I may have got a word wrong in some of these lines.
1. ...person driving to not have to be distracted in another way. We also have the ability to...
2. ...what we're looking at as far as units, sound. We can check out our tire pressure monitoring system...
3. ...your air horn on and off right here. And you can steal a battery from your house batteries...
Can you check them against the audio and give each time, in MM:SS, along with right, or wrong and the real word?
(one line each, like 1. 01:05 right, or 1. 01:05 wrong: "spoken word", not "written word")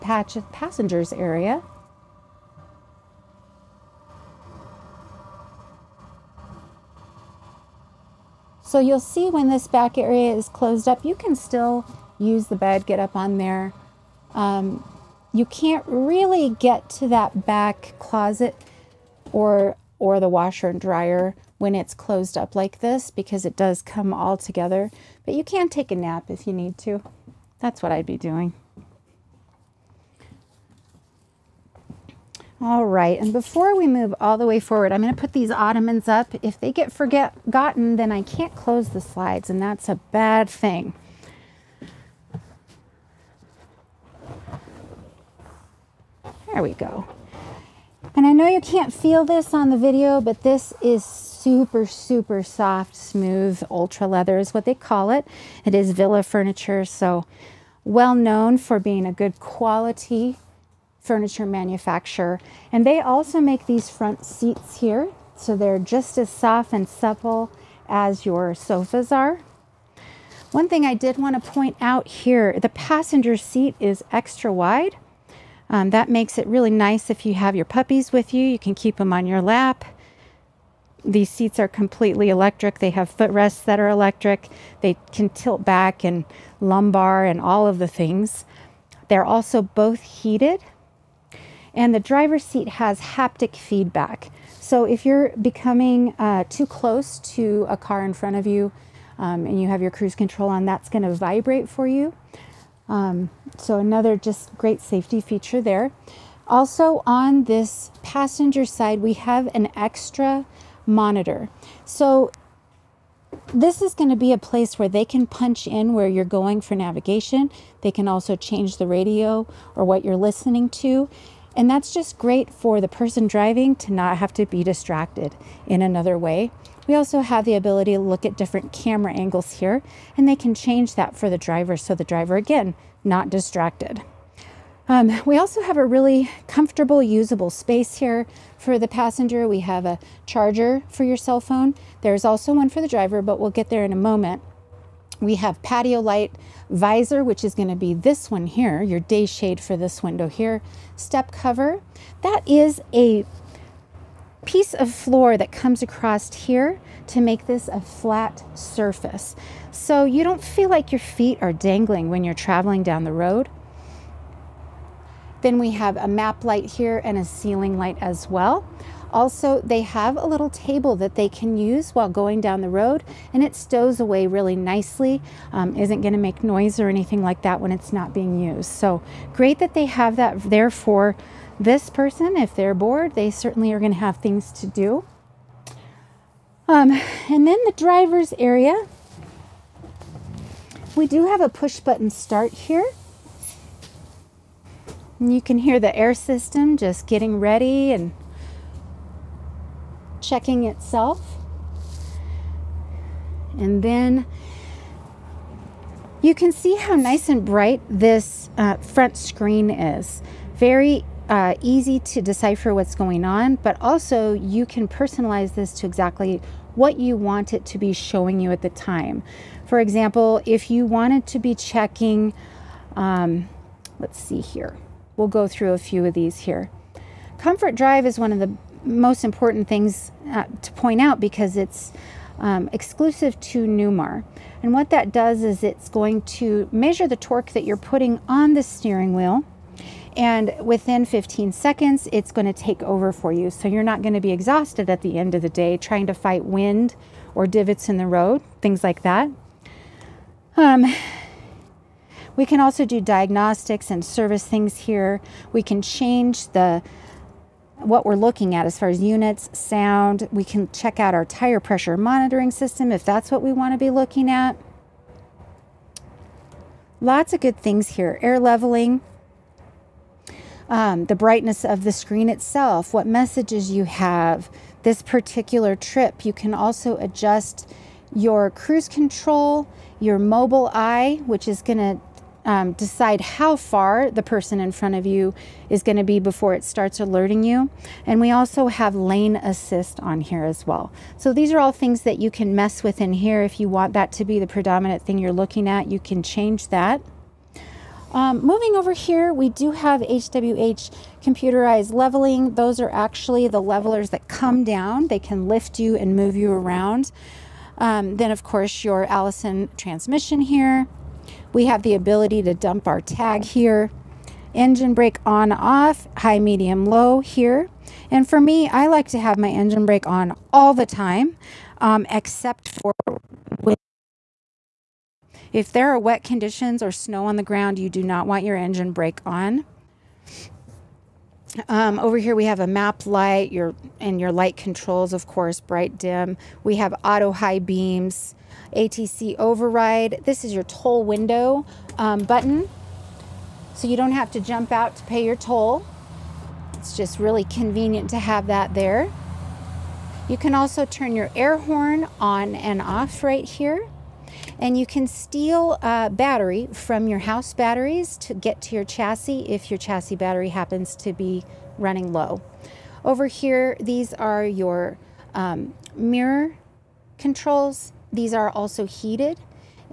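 1. 02:02 right
2. 04:17 right
3. 05:51 right.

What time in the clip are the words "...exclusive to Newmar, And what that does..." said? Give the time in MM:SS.
03:52.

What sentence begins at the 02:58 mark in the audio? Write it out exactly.
So great that they have that there for this person.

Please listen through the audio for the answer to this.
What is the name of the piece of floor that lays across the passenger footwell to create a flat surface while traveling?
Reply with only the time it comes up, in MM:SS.
02:30.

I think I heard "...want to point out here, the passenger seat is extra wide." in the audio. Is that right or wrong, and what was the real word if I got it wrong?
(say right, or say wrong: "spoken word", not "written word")
right.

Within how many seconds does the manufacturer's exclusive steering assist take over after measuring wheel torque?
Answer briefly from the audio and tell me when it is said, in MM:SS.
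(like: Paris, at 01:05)
15 seconds, at 04:01.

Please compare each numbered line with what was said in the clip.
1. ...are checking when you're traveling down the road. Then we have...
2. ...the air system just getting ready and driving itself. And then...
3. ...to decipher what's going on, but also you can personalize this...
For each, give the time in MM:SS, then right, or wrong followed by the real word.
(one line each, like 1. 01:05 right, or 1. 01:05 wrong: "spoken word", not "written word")
1. 02:41 wrong: "dangling", not "checking"
2. 03:15 wrong: "checking", not "driving"
3. 03:31 right.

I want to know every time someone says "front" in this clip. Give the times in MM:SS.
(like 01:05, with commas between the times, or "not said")
01:03, 01:38, 03:28, 04:44.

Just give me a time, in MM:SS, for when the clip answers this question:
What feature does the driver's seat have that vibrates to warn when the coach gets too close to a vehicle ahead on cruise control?
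01:32.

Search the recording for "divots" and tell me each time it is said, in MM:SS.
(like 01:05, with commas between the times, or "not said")
04:07.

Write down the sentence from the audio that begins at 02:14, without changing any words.
Um, we also have a really comfortable, usable space here for the passenger.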